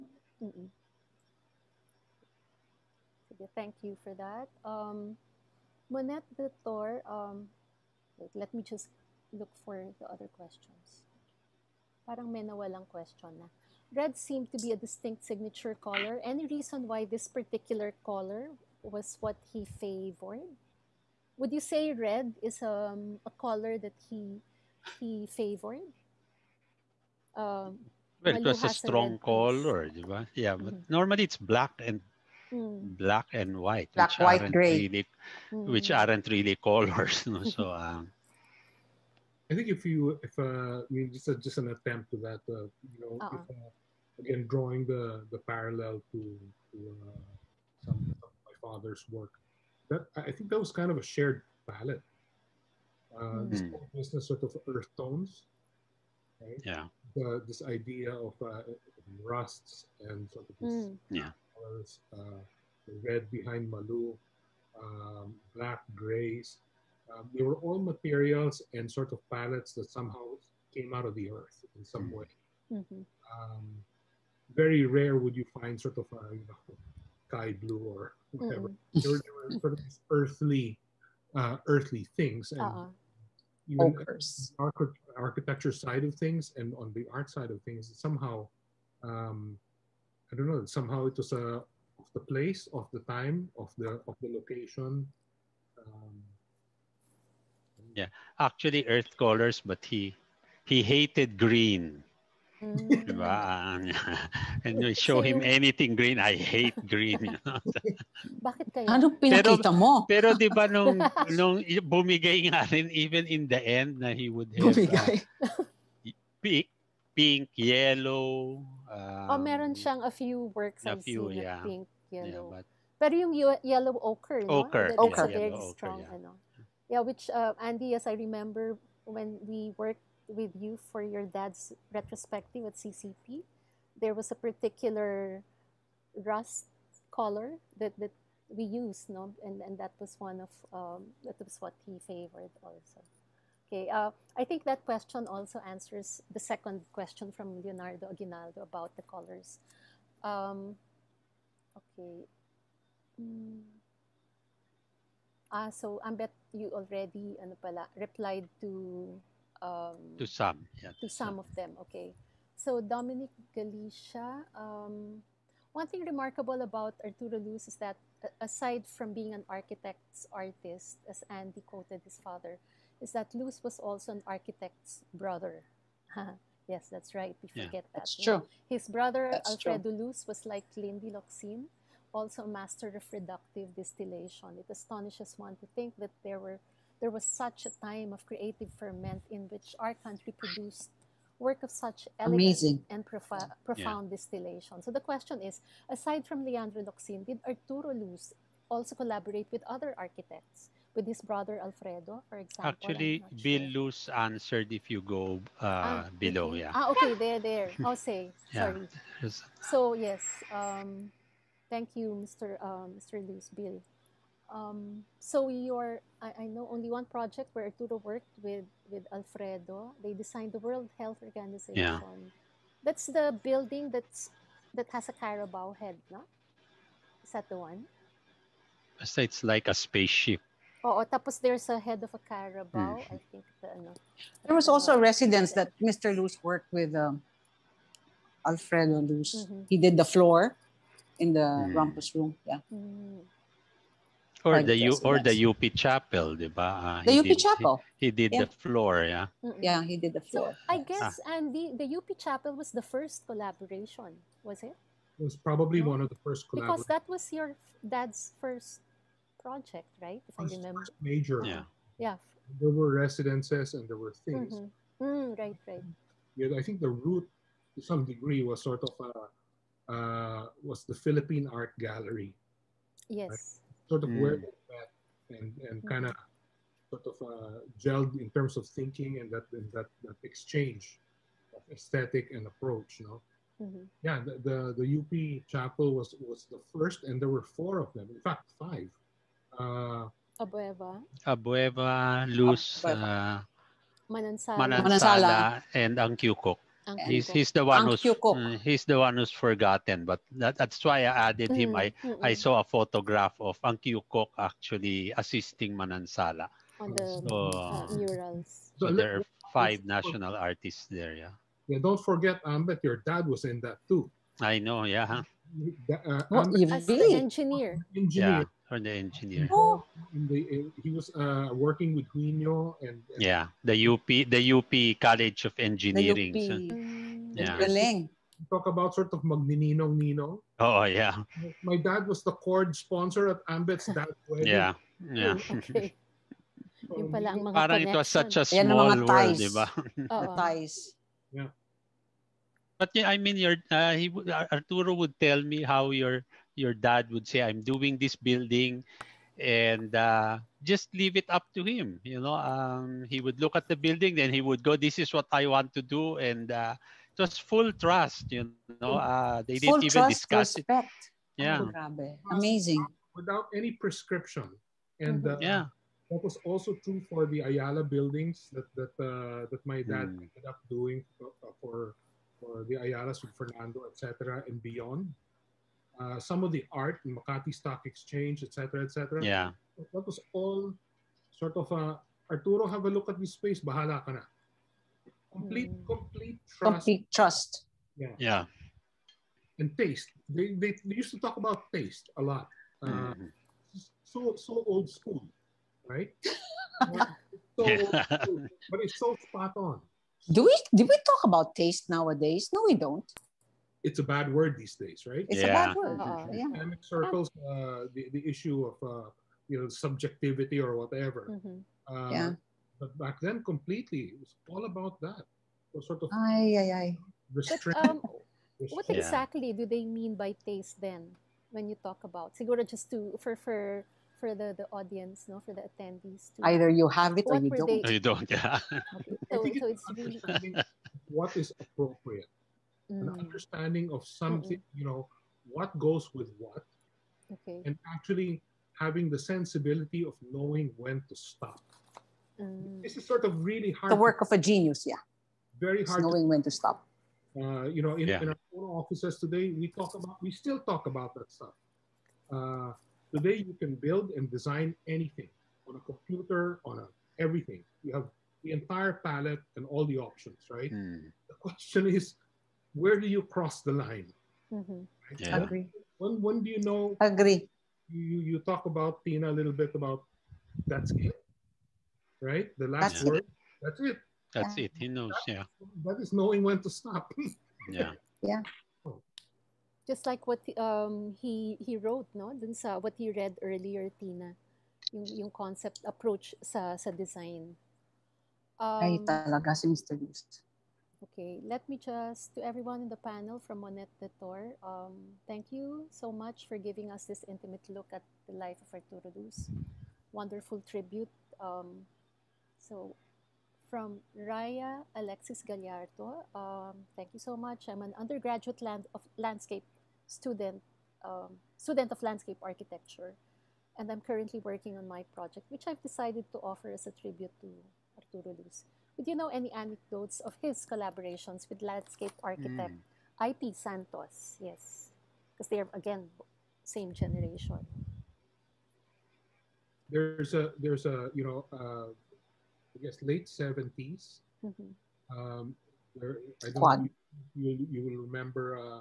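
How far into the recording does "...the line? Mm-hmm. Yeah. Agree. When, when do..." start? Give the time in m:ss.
7:43.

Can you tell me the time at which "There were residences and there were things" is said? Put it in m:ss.
4:22.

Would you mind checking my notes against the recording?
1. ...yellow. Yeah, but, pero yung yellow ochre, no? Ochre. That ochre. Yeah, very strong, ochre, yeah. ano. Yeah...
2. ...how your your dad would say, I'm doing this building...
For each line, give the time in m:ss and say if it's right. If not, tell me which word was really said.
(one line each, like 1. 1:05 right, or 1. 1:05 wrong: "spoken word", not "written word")
1. 2:02 right
2. 5:45 right.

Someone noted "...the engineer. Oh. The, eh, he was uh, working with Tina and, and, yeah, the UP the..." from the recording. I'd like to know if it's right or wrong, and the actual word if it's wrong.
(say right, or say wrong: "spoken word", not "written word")
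wrong: "Huino", not "Tina".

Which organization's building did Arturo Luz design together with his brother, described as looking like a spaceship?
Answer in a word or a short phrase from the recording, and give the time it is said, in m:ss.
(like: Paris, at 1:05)
World Health Organization, at 3:40.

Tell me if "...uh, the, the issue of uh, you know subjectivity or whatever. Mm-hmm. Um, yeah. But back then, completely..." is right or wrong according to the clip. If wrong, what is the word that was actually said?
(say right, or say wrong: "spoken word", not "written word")
right.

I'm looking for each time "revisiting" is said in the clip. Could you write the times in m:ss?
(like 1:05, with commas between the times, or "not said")
not said.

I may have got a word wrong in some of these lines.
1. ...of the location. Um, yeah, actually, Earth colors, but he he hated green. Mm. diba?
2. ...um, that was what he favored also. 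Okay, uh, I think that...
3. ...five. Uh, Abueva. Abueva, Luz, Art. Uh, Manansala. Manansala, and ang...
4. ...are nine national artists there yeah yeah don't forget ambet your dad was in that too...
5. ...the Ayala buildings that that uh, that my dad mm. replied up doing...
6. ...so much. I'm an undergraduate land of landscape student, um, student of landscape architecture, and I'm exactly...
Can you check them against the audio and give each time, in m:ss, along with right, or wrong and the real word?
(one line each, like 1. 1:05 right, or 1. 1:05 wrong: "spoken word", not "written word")
1. 1:34 right
2. 2:20 right
3. 4:48 wrong: "Abueva", not "Art"
4. 5:09 wrong: "five", not "nine"
5. 6:07 wrong: "ended", not "replied"
6. 8:27 wrong: "currently", not "exactly".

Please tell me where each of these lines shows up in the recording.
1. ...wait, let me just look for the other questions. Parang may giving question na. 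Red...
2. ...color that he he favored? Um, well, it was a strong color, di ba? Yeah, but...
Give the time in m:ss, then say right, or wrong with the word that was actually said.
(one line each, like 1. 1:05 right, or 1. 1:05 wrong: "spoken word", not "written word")
1. 0:08 wrong: "nawalang", not "giving"
2. 0:23 right.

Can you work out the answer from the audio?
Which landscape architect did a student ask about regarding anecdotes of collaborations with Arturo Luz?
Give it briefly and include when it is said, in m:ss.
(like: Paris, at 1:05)
I.P. Santos, at 8:43.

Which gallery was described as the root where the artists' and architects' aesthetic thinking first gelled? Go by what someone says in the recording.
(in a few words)
Philippine Art Gallery.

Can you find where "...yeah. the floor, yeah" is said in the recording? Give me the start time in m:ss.
4:08.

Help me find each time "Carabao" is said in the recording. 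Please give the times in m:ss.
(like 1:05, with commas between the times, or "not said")
3:45, 3:52.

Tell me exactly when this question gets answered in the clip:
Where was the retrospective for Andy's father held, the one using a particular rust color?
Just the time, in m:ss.
2:12.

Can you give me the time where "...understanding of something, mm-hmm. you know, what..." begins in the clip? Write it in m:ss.
7:13.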